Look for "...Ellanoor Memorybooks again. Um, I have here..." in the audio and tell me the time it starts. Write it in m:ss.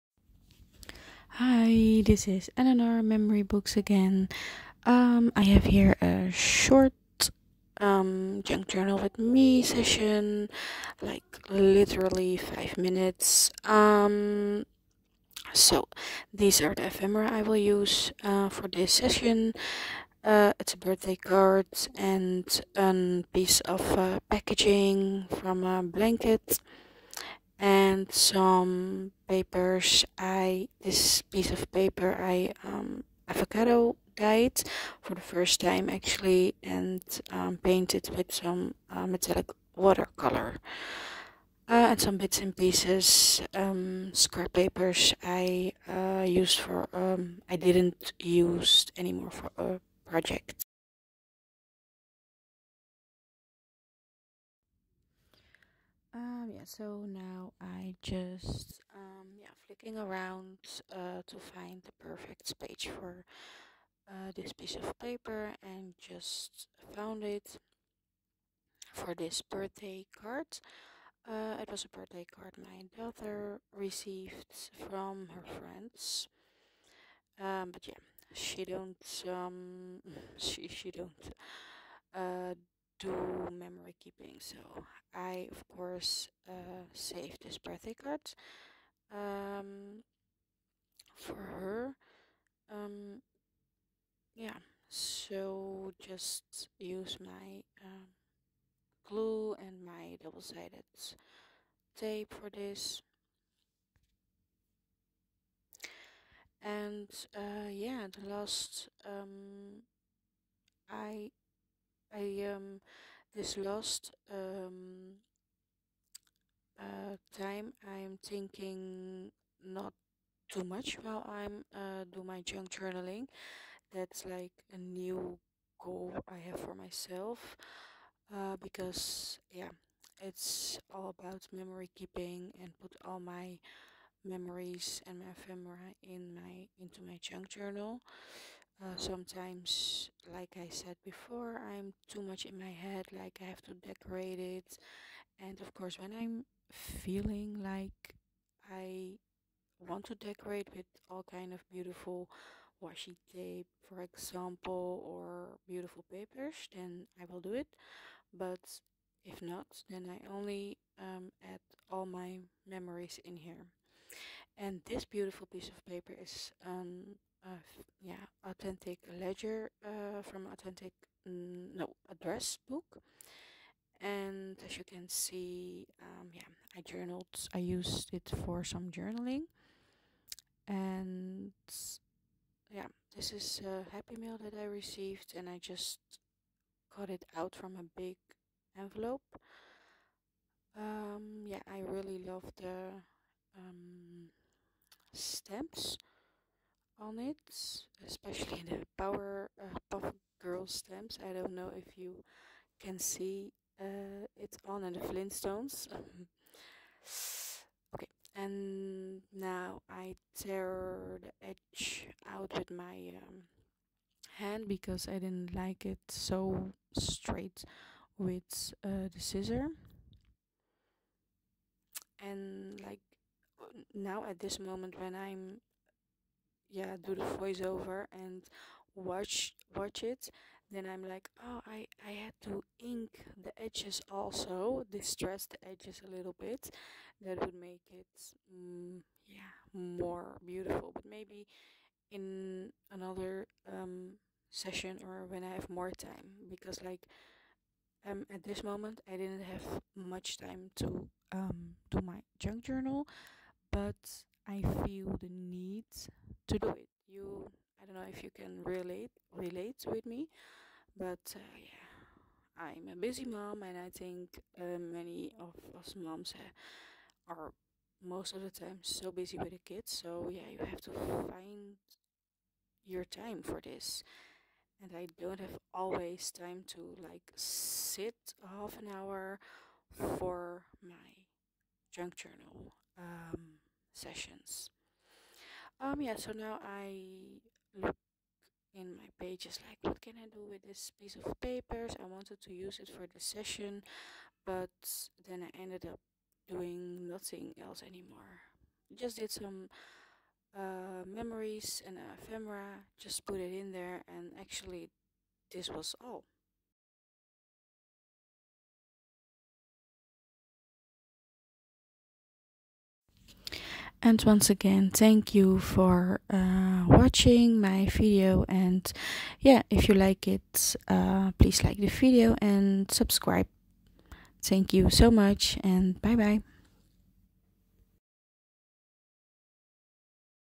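0:02.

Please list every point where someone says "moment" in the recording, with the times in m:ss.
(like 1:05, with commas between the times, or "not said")
3:44, 4:08.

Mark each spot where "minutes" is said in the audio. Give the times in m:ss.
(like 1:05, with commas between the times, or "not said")
0:12.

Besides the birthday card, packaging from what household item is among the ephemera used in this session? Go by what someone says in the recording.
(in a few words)
A blanket.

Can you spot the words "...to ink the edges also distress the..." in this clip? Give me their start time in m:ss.
3:52.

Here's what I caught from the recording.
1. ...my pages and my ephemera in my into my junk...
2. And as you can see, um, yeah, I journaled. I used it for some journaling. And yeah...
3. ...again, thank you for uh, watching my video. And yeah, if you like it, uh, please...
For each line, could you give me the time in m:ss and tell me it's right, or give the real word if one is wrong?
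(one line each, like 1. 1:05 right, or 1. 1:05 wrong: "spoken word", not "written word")
1. 2:13 wrong: "memories", not "pages"
2. 2:54 right
3. 5:14 right.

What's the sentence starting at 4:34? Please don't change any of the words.
And I don't have always time to like sit half an hour for my junk journal.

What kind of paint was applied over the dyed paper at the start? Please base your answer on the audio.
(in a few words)
Metallic watercolor.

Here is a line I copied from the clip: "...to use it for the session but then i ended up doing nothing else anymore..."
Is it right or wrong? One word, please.
right.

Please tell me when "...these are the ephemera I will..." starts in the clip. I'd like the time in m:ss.
0:16.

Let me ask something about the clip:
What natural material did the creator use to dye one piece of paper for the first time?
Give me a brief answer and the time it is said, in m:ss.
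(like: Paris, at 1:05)
Avocado, at 0:33.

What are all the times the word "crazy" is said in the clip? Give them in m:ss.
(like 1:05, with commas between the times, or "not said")
not said.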